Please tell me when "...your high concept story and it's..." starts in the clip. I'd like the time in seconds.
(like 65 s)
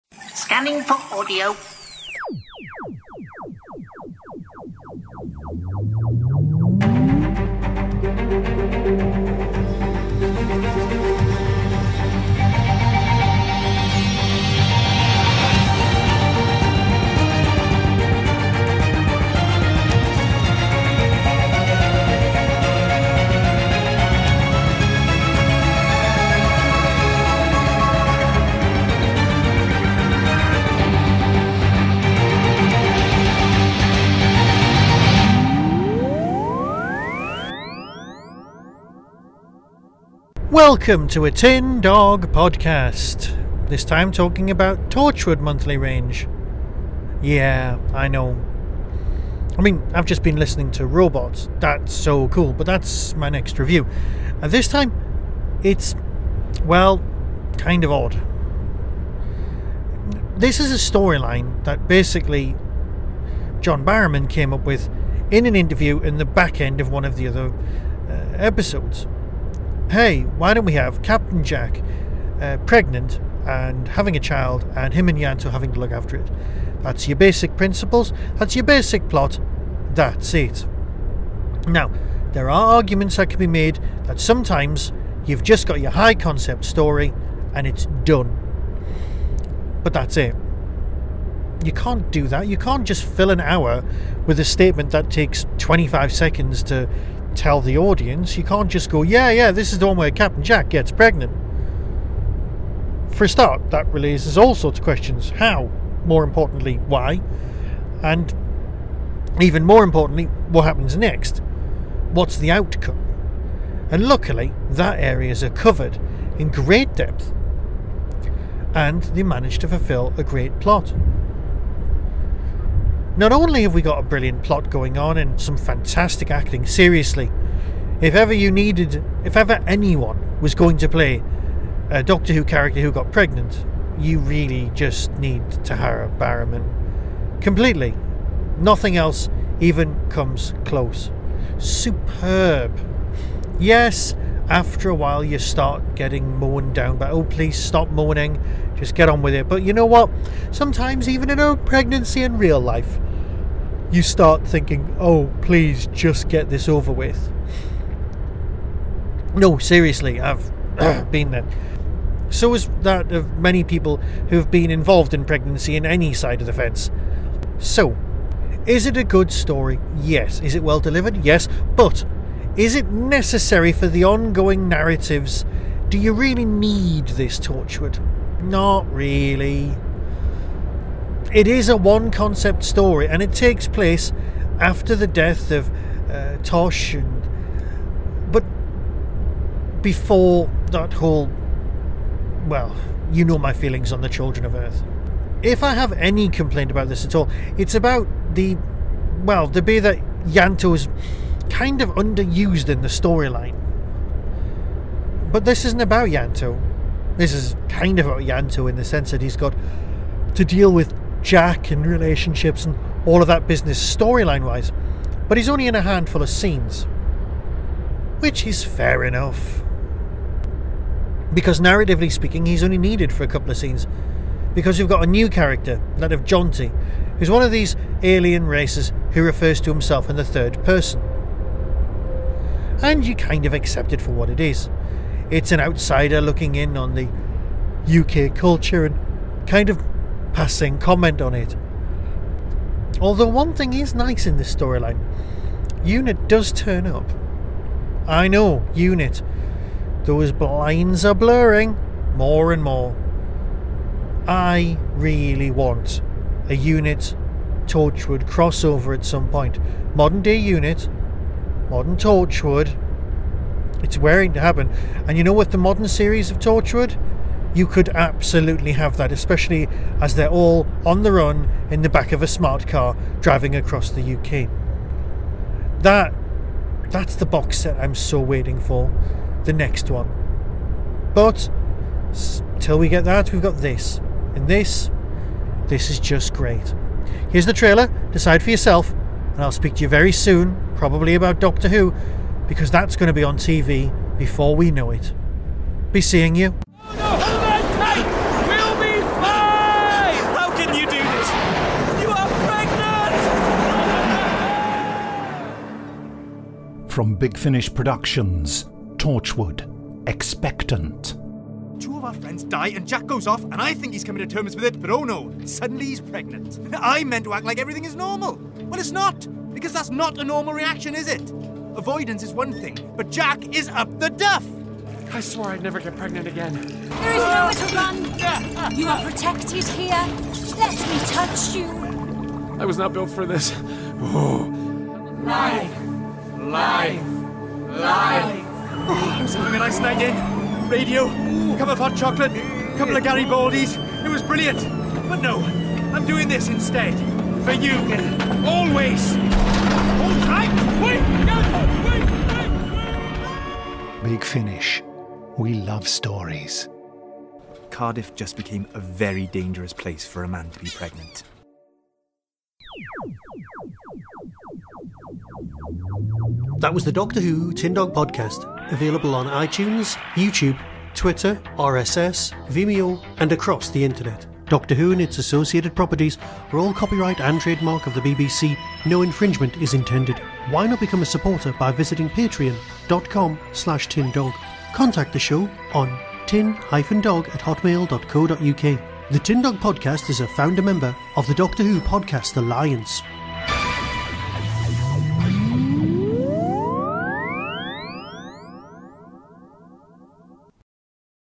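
85 s.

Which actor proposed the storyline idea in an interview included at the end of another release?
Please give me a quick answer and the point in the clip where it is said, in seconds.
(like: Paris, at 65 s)
John Barrowman, at 63 s.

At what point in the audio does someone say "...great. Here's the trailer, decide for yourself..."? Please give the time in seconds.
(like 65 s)
286 s.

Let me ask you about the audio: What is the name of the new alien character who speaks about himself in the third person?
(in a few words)
Jonty.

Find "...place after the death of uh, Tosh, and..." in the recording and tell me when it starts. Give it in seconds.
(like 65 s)
183 s.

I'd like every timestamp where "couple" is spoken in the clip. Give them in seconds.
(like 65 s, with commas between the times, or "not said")
223 s, 342 s.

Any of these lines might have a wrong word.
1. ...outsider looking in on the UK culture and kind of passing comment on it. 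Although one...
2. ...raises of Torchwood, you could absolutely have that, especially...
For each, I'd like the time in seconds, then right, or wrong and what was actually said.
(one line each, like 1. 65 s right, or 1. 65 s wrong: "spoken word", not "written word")
1. 235 s right
2. 265 s wrong: "series", not "raises".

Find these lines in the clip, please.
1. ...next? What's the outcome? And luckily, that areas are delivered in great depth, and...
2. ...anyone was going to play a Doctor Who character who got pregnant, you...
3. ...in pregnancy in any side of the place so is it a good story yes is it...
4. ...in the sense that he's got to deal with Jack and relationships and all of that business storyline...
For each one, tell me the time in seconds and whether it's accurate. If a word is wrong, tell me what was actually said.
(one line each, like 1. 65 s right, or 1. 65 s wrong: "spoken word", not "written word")
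1. 110 s wrong: "covered", not "delivered"
2. 129 s right
3. 165 s wrong: "fence", not "place"
4. 208 s right.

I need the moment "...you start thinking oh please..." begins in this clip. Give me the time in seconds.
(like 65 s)
153 s.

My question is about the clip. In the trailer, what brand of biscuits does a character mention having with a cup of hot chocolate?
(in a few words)
Garibaldis.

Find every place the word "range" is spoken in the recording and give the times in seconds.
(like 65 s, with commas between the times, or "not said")
45 s.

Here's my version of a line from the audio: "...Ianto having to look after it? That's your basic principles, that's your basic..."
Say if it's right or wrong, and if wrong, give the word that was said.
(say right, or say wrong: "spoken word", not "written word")
right.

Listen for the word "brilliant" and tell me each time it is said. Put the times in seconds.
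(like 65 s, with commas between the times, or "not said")
124 s, 344 s.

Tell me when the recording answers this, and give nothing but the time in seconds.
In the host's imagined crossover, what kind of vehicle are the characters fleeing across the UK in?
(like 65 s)
272 s.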